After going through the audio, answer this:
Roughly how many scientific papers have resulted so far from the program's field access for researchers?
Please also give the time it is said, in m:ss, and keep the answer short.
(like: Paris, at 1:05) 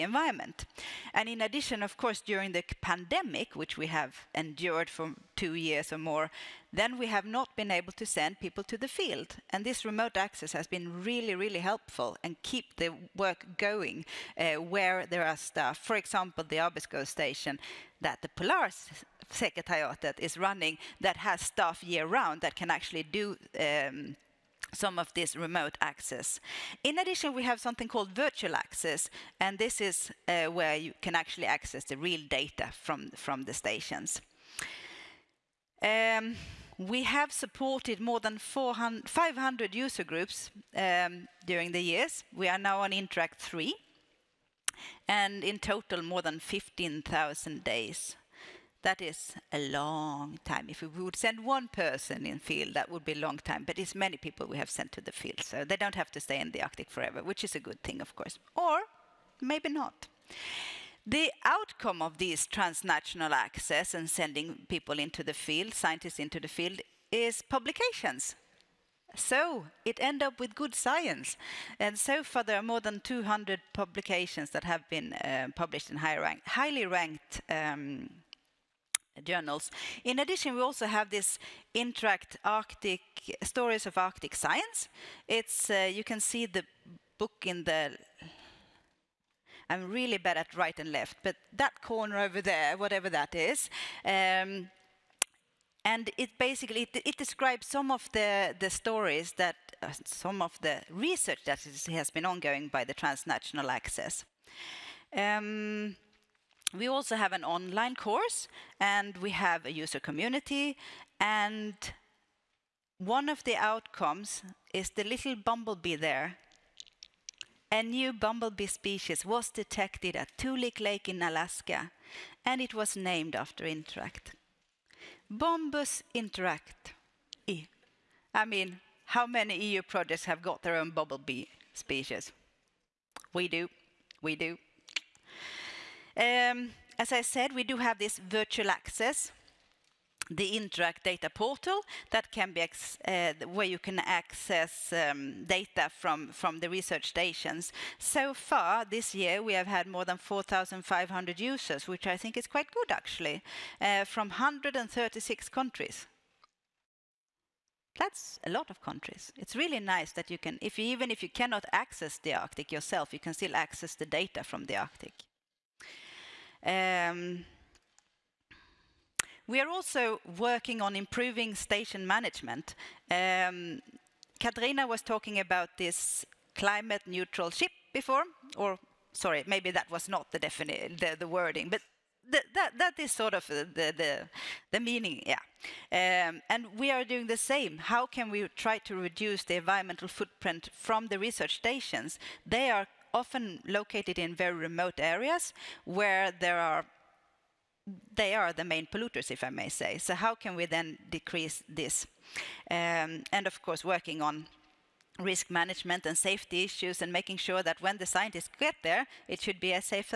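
More than 200, at 1:12.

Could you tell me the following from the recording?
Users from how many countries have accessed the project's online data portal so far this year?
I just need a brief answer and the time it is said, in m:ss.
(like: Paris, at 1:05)
136, at 2:34.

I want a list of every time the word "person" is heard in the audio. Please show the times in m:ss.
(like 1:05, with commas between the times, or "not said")
0:51.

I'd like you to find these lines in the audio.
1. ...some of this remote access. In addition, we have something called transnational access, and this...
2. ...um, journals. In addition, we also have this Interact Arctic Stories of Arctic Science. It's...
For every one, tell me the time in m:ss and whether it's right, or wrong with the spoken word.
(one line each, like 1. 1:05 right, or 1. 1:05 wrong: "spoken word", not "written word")
1. 0:24 wrong: "virtual", not "transnational"
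2. 1:17 right.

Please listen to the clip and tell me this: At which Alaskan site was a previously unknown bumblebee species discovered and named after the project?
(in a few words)
Toolik Lake.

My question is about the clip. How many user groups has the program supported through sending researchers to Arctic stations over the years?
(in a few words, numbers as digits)
More than 500.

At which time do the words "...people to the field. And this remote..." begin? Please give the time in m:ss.
0:08.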